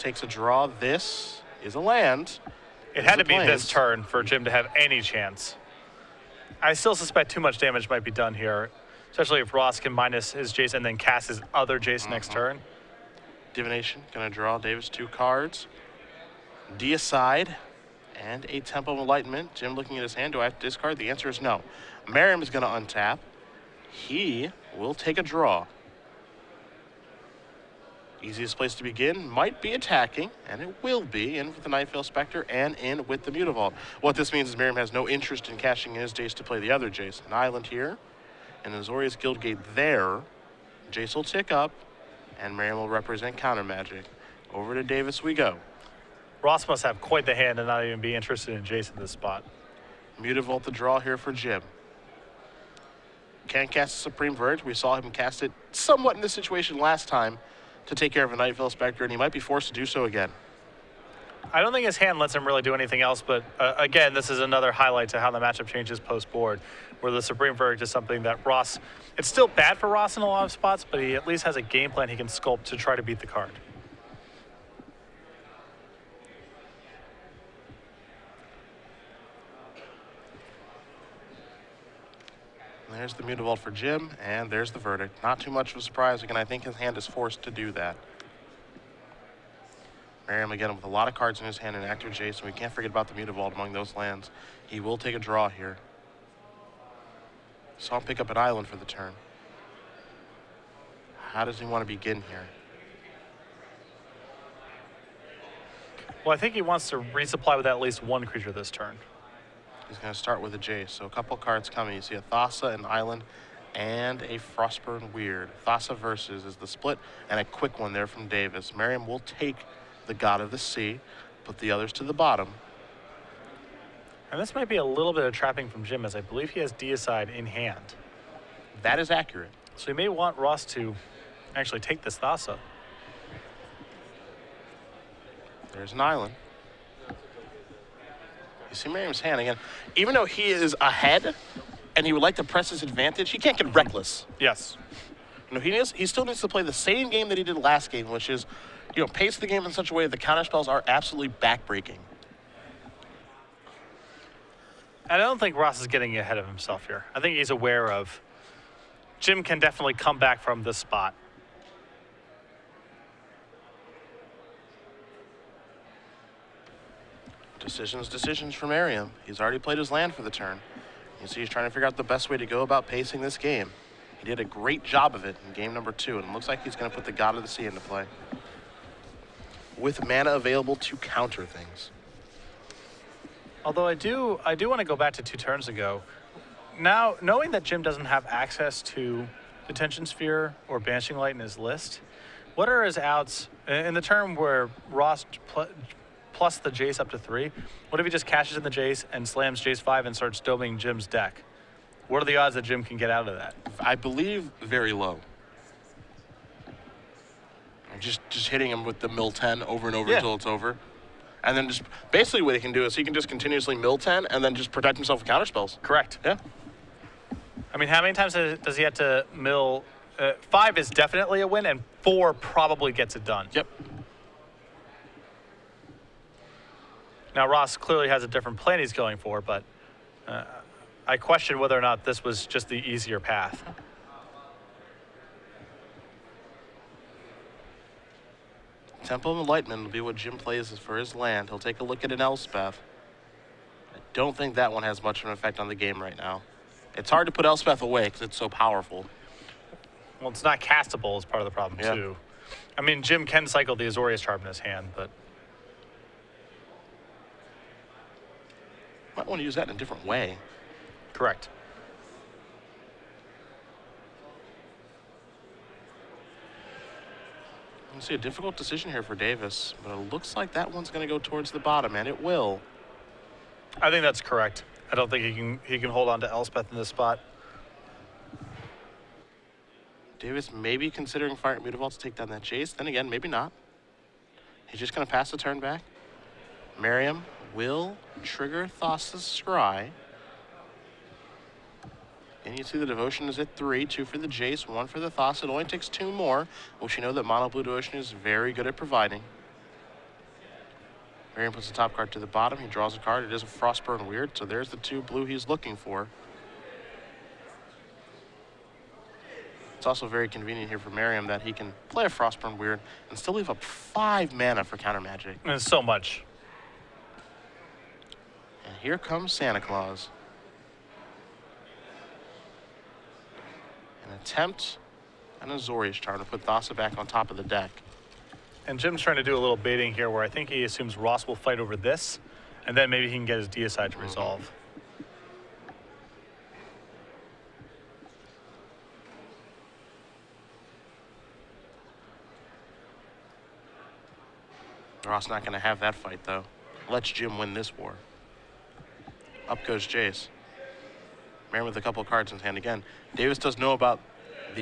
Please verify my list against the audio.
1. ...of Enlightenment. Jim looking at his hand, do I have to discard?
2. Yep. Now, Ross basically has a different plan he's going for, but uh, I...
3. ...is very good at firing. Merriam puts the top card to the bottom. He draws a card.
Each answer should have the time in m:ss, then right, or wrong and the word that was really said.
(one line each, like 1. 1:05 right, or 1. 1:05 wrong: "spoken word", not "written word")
1. 0:18 right
2. 3:43 wrong: "clearly", not "basically"
3. 4:57 wrong: "providing", not "firing".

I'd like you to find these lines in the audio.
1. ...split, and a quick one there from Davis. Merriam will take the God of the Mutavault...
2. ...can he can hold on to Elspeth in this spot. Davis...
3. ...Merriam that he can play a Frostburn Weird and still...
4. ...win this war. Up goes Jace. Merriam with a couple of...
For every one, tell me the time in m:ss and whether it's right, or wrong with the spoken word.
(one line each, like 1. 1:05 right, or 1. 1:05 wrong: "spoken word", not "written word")
1. 1:56 wrong: "Sea", not "Mutavault"
2. 4:35 right
3. 5:10 right
4. 5:47 right.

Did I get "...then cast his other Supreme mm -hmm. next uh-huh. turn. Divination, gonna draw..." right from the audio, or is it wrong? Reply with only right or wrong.
wrong.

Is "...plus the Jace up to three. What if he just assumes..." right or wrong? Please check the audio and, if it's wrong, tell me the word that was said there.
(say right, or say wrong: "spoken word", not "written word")
wrong: "cashes", not "assumes".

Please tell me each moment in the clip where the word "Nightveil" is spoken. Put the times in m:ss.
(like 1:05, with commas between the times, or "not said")
0:31, 0:58.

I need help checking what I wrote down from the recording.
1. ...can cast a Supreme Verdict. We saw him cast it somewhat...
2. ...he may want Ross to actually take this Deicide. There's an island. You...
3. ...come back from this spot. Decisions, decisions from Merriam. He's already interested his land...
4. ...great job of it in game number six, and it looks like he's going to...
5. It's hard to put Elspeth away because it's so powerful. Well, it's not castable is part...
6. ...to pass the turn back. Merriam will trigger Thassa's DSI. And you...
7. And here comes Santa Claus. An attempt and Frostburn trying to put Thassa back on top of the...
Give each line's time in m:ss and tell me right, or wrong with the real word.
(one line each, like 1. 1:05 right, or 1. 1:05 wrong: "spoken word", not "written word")
1. 0:53 right
2. 2:09 wrong: "Thassa", not "Deicide"
3. 2:39 wrong: "played", not "interested"
4. 2:54 wrong: "two", not "six"
5. 4:06 right
6. 4:45 wrong: "Scry", not "DSI"
7. 5:18 wrong: "Azorius", not "Frostburn".